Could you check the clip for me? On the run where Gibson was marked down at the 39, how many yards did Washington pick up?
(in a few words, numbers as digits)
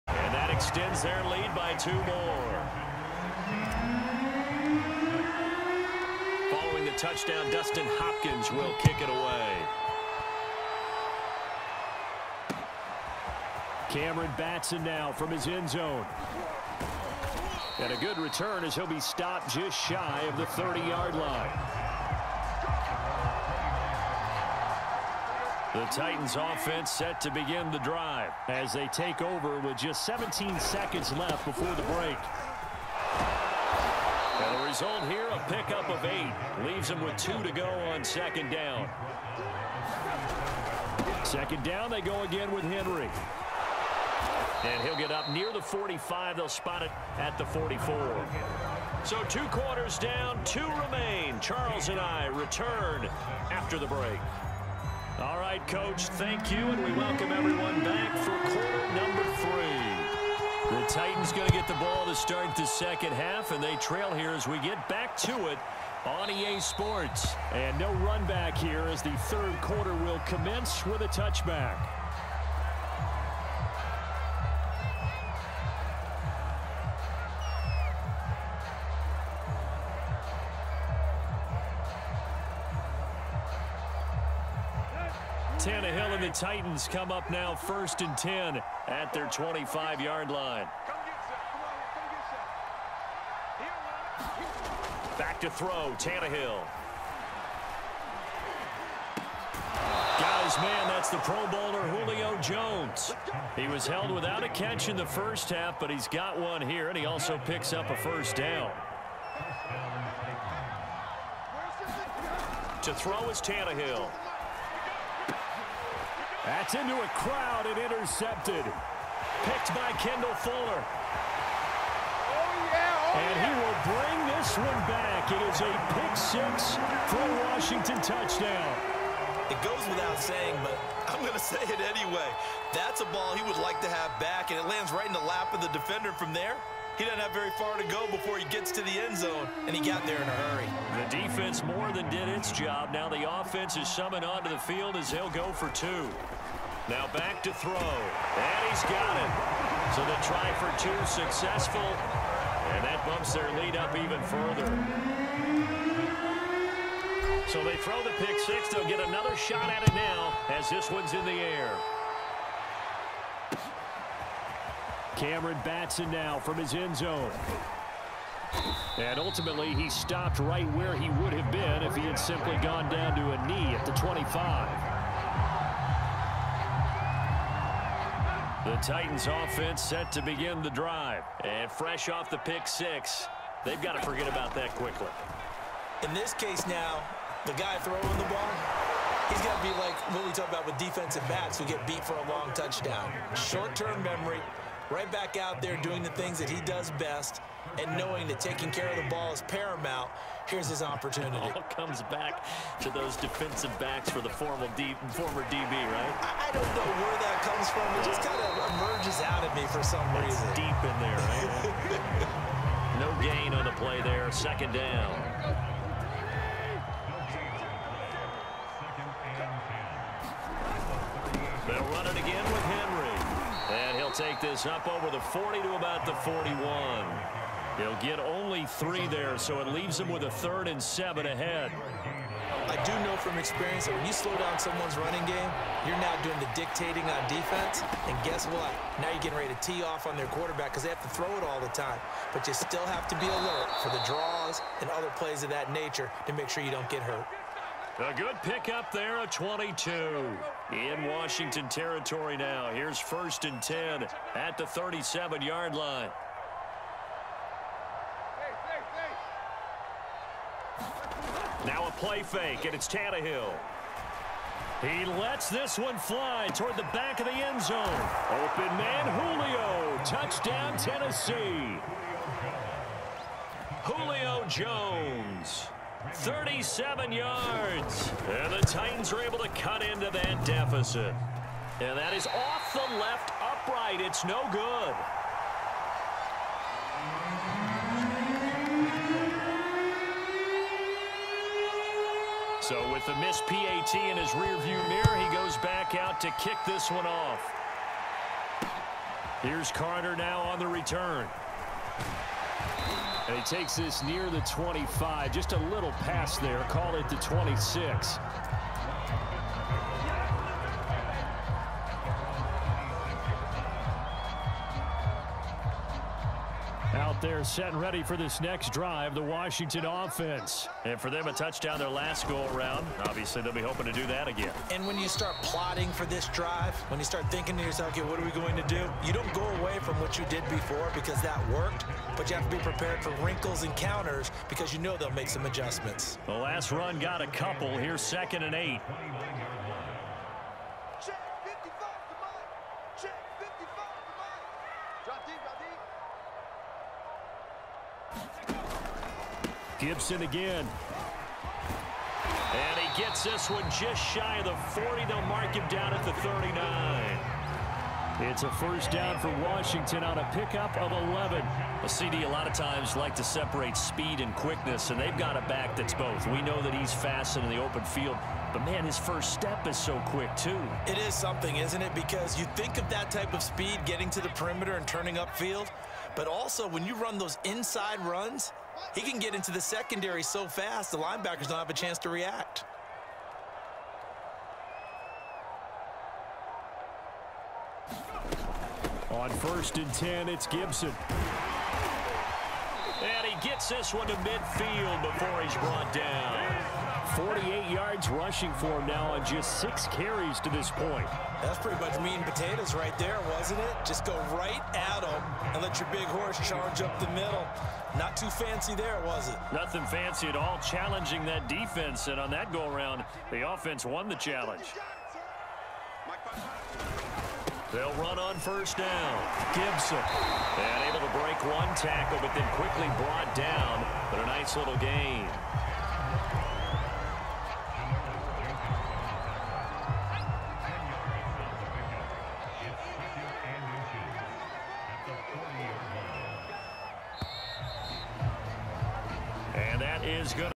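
11.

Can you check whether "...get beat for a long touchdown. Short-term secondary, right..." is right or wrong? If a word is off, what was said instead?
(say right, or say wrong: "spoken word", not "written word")
wrong: "memory", not "secondary".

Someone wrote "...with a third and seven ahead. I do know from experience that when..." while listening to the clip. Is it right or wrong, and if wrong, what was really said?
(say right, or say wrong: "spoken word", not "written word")
right.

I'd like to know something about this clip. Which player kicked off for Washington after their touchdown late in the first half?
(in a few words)
Dustin Hopkins.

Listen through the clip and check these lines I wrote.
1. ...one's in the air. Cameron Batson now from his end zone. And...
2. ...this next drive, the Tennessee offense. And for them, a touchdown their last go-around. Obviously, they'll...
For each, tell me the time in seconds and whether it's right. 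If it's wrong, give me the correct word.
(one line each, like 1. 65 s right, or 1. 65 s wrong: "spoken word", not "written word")
1. 160 s right
2. 318 s wrong: "Washington", not "Tennessee".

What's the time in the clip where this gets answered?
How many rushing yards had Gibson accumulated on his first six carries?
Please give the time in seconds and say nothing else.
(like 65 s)
397 s.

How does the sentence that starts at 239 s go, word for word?
Now you're getting ready to tee off on their quarterback because they have to throw it all the time.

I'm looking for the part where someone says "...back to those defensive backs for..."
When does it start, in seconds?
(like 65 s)
202 s.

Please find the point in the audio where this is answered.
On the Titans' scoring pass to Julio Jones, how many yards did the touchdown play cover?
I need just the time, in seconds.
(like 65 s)
276 s.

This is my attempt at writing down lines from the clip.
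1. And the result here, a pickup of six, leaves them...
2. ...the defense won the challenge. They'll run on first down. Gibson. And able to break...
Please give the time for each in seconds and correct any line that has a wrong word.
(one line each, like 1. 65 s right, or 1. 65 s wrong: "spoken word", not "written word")
1. 34 s wrong: "eight", not "six"
2. 413 s wrong: "offense", not "defense".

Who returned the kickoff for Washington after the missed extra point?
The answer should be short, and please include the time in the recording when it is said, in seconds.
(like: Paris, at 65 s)
Carter, at 299 s.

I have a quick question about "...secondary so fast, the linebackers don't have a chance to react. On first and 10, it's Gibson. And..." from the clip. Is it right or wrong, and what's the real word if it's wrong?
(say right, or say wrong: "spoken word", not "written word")
right.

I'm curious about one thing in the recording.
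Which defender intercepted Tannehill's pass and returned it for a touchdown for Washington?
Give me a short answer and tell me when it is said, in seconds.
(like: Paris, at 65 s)
Kendall Fuller, at 120 s.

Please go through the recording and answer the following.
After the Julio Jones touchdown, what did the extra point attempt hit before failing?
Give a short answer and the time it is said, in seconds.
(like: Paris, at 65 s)
left upright, at 282 s.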